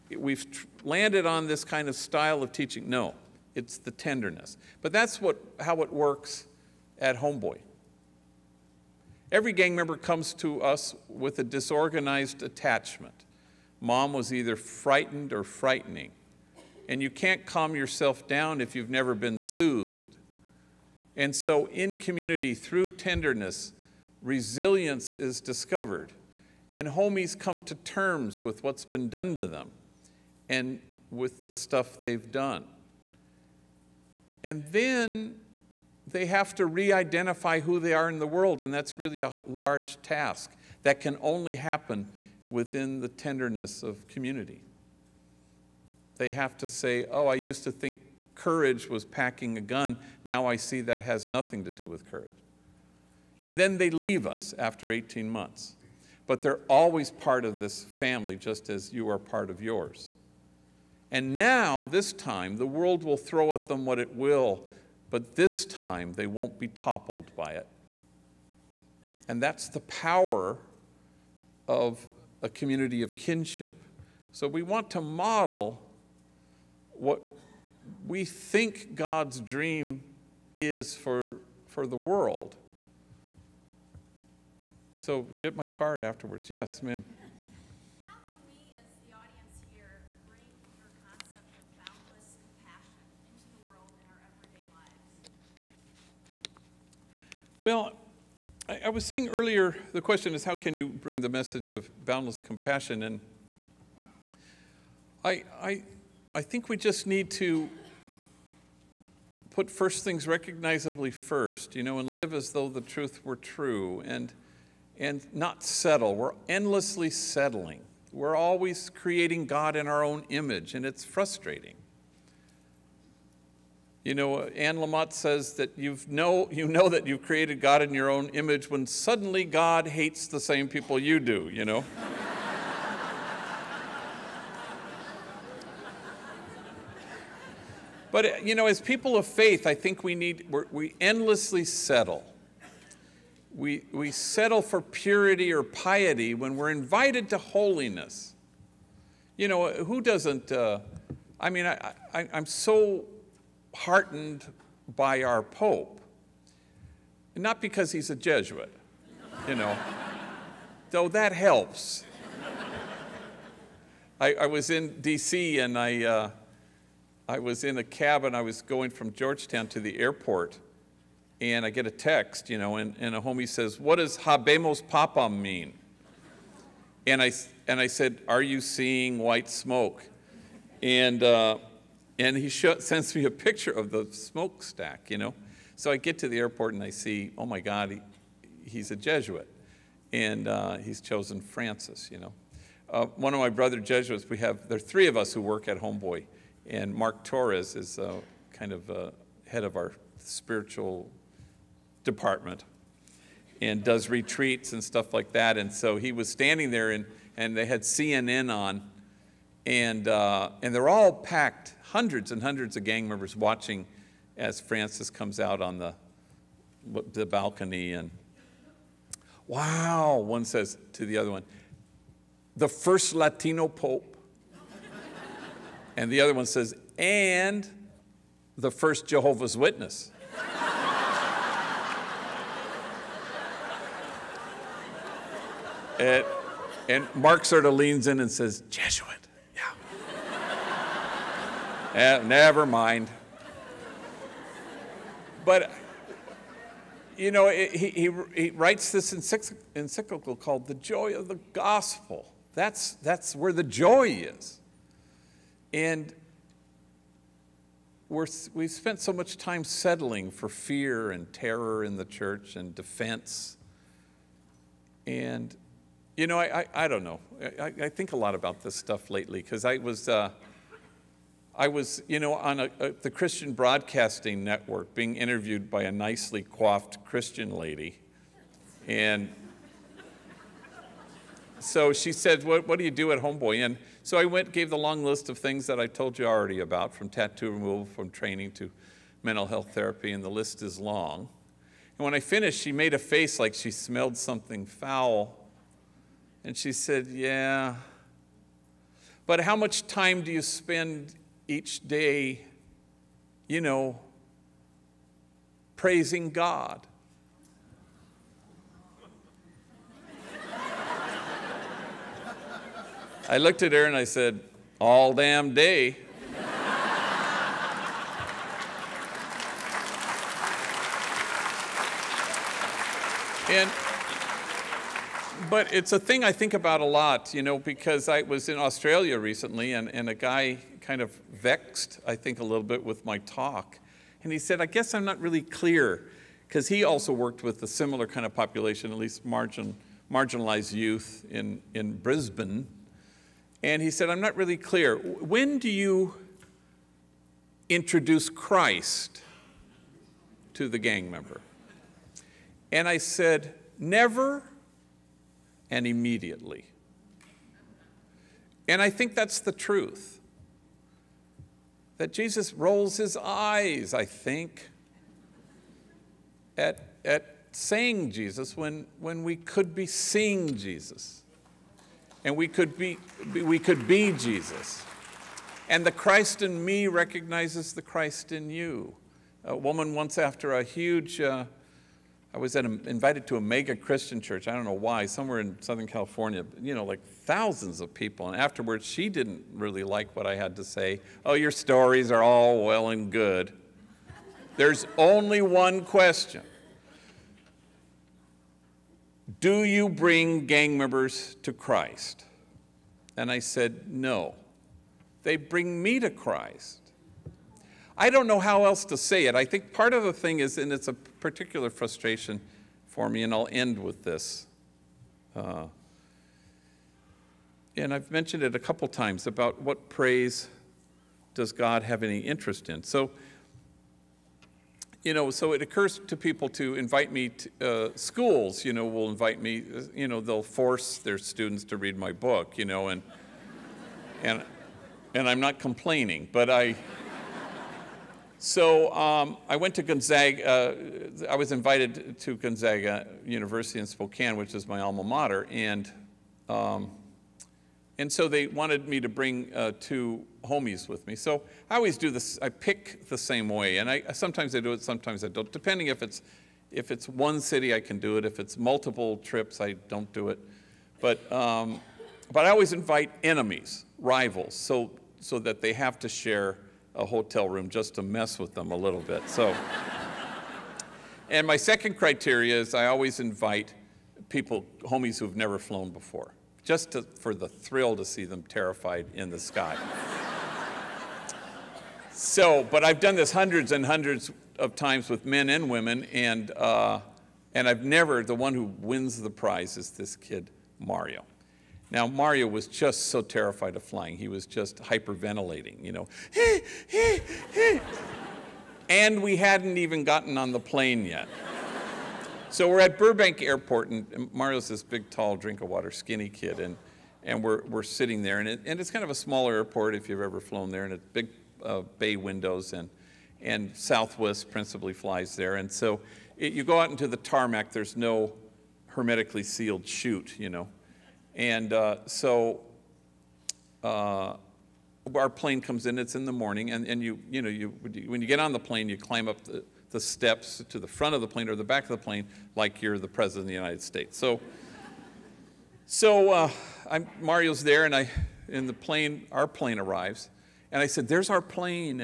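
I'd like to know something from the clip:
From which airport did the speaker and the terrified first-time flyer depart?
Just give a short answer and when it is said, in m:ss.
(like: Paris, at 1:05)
Burbank Airport, at 8:22.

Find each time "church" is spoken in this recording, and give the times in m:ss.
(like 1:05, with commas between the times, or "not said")
4:22, 6:24.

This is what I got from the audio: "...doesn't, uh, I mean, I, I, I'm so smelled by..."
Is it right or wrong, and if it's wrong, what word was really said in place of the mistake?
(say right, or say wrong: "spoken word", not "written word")
wrong: "heartened", not "smelled".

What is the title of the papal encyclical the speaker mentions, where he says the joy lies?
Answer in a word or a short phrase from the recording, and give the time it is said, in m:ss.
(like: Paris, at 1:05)
The Joy of the Gospel, at 4:10.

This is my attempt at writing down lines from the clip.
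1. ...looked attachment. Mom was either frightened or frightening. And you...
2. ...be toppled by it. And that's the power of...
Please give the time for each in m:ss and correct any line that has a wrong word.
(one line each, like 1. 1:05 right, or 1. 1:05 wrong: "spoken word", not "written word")
1. 0:11 wrong: "disorganized", not "looked"
2. 1:06 right.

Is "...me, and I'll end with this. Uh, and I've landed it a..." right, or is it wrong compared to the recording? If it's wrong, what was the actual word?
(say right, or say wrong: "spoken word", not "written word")
wrong: "mentioned", not "landed".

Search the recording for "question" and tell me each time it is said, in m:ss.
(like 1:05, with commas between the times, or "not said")
1:40, 6:35.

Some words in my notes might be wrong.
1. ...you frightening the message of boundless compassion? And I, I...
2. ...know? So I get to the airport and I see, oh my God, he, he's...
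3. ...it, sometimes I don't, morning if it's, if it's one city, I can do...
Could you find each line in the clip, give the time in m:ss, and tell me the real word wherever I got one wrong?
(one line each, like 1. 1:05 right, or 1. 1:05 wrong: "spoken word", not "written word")
1. 1:40 wrong: "bring", not "frightening"
2. 3:05 right
3. 7:34 wrong: "depending", not "morning".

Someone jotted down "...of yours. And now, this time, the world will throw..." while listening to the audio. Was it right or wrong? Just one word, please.
right.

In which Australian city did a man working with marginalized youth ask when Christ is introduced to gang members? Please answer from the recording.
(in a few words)
Brisbane.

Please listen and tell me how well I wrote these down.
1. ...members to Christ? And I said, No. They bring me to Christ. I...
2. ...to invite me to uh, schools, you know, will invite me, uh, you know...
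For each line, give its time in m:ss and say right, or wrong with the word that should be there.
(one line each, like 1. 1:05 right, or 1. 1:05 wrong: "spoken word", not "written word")
1. 6:40 right
2. 7:06 right.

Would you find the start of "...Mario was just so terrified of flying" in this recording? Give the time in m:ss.
8:12.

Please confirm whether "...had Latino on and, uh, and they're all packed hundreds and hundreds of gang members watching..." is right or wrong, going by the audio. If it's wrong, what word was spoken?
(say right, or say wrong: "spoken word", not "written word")
wrong: "CNN", not "Latino".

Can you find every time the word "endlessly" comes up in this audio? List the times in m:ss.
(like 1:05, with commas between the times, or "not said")
1:56, 2:20.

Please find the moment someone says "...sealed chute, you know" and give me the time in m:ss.
8:39.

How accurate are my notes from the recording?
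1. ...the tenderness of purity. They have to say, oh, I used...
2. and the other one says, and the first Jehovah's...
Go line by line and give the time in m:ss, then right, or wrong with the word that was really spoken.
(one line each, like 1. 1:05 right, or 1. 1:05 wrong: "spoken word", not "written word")
1. 0:43 wrong: "community", not "purity"
2. 3:45 right.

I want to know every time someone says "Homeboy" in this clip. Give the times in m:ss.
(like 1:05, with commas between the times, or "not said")
0:07, 3:15, 4:43.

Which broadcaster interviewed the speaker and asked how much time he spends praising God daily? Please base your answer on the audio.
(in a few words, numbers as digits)
Christian Broadcasting Network.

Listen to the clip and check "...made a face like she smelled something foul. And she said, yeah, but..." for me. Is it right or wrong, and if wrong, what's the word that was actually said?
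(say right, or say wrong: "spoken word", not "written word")
right.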